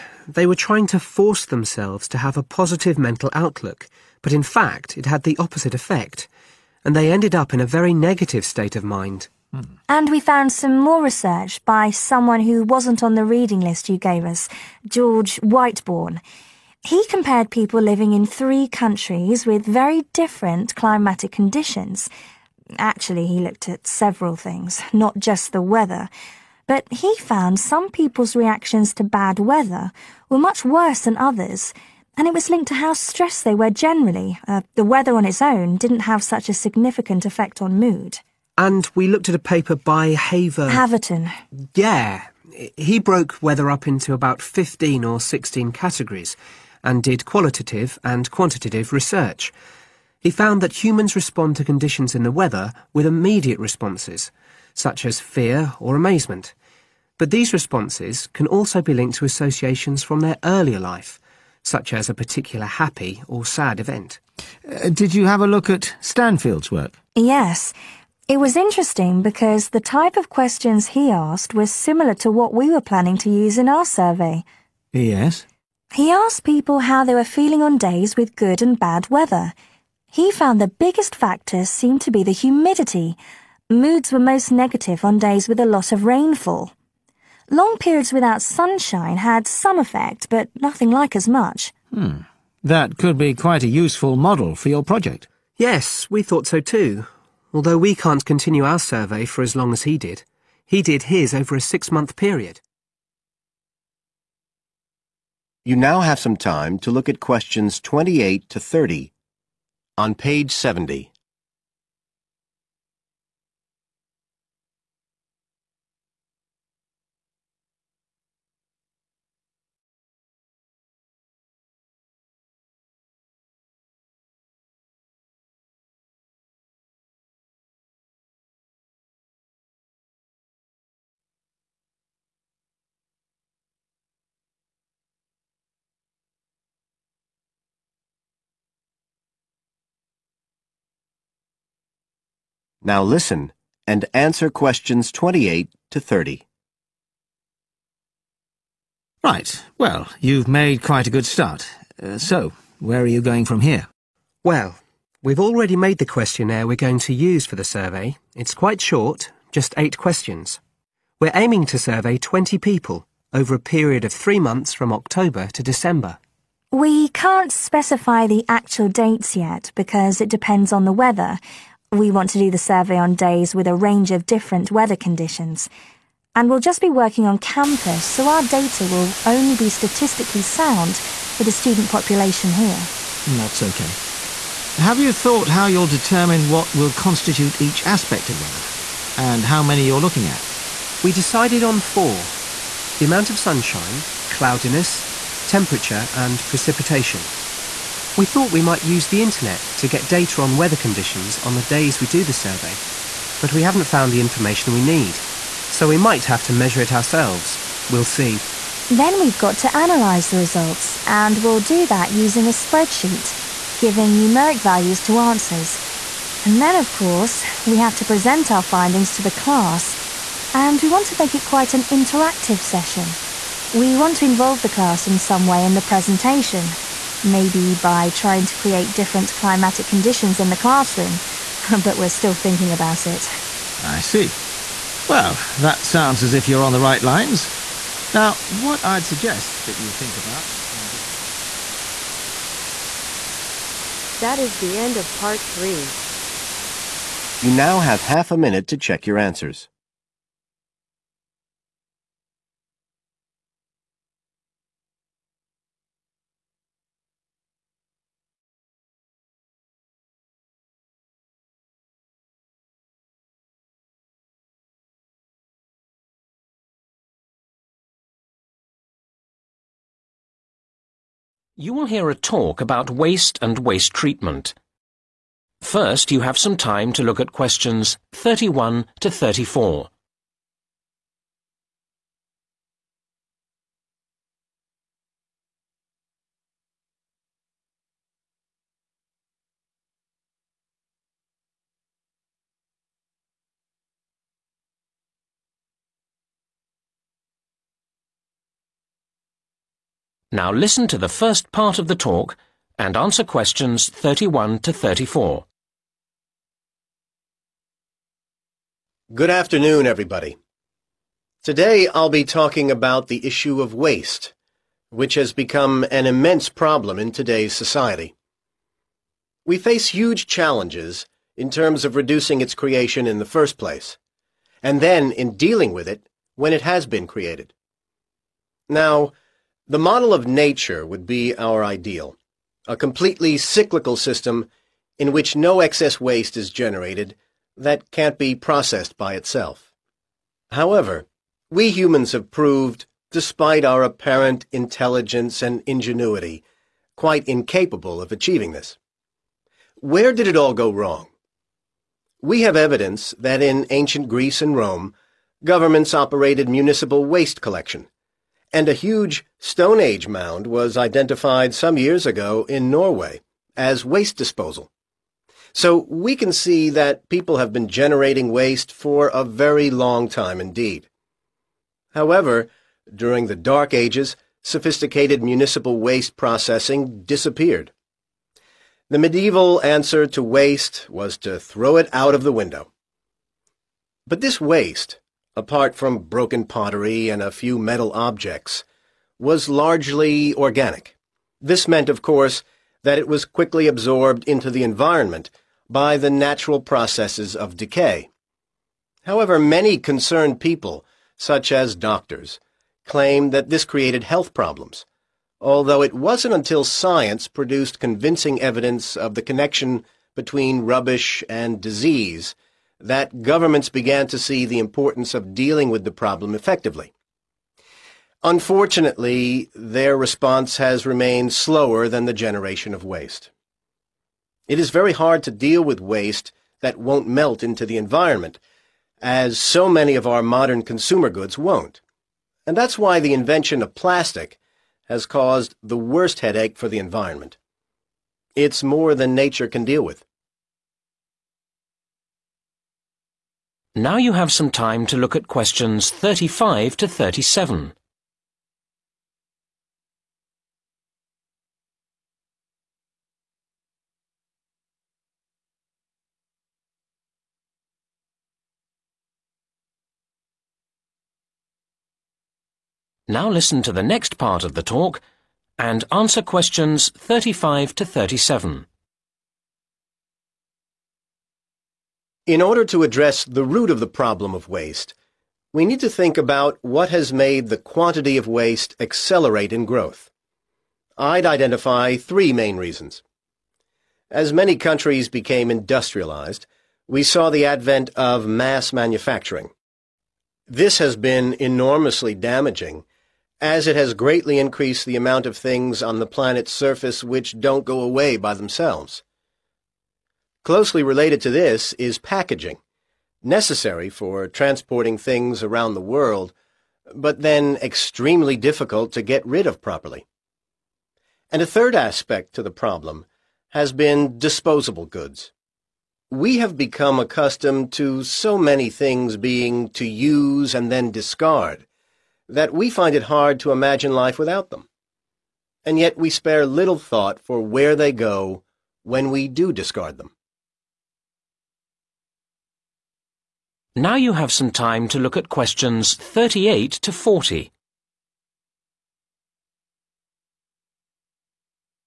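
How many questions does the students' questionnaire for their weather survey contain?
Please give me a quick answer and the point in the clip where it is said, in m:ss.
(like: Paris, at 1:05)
8, at 2:39.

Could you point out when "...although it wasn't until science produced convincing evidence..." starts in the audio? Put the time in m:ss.
6:45.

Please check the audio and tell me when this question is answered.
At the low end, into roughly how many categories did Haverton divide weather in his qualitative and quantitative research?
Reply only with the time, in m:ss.
0:44.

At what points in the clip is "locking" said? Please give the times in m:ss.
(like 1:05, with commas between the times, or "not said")
not said.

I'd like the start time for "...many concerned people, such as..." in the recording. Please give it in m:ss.
6:39.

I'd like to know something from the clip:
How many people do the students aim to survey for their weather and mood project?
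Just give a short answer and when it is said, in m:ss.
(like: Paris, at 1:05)
20, at 2:42.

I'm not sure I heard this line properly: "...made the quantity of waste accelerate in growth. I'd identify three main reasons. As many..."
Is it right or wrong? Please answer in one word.
right.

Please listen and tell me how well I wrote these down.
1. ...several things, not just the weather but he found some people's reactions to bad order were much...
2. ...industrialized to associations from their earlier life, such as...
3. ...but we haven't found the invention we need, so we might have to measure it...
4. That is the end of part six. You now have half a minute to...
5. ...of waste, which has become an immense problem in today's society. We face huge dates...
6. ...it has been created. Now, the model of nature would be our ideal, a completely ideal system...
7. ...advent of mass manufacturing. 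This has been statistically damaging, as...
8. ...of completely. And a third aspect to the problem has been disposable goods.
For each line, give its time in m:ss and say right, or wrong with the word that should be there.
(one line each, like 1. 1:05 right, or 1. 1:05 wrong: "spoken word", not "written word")
1. 0:23 wrong: "weather", not "order"
2. 0:58 wrong: "linked", not "industrialized"
3. 3:23 wrong: "information", not "invention"
4. 4:04 wrong: "three", not "six"
5. 5:13 wrong: "challenges", not "dates"
6. 5:26 wrong: "cyclical", not "ideal"
7. 8:07 wrong: "enormously", not "statistically"
8. 8:29 wrong: "properly", not "completely".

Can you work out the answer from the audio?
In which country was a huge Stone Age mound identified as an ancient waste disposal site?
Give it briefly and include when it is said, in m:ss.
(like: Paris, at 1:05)
Norway, at 6:02.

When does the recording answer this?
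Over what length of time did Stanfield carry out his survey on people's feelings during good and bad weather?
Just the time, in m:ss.
1:41.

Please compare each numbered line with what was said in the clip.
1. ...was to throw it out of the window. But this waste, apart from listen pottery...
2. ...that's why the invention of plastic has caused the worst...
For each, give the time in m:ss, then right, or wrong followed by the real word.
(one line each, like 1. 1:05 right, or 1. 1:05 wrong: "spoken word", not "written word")
1. 6:20 wrong: "broken", not "listen"
2. 7:12 right.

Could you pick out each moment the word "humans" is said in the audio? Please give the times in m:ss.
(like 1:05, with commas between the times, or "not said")
0:50, 5:41.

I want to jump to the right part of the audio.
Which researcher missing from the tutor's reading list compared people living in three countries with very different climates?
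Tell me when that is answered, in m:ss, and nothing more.
0:14.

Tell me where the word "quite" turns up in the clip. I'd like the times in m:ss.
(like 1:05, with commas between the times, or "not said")
1:33, 2:30, 2:38, 3:41, 5:46.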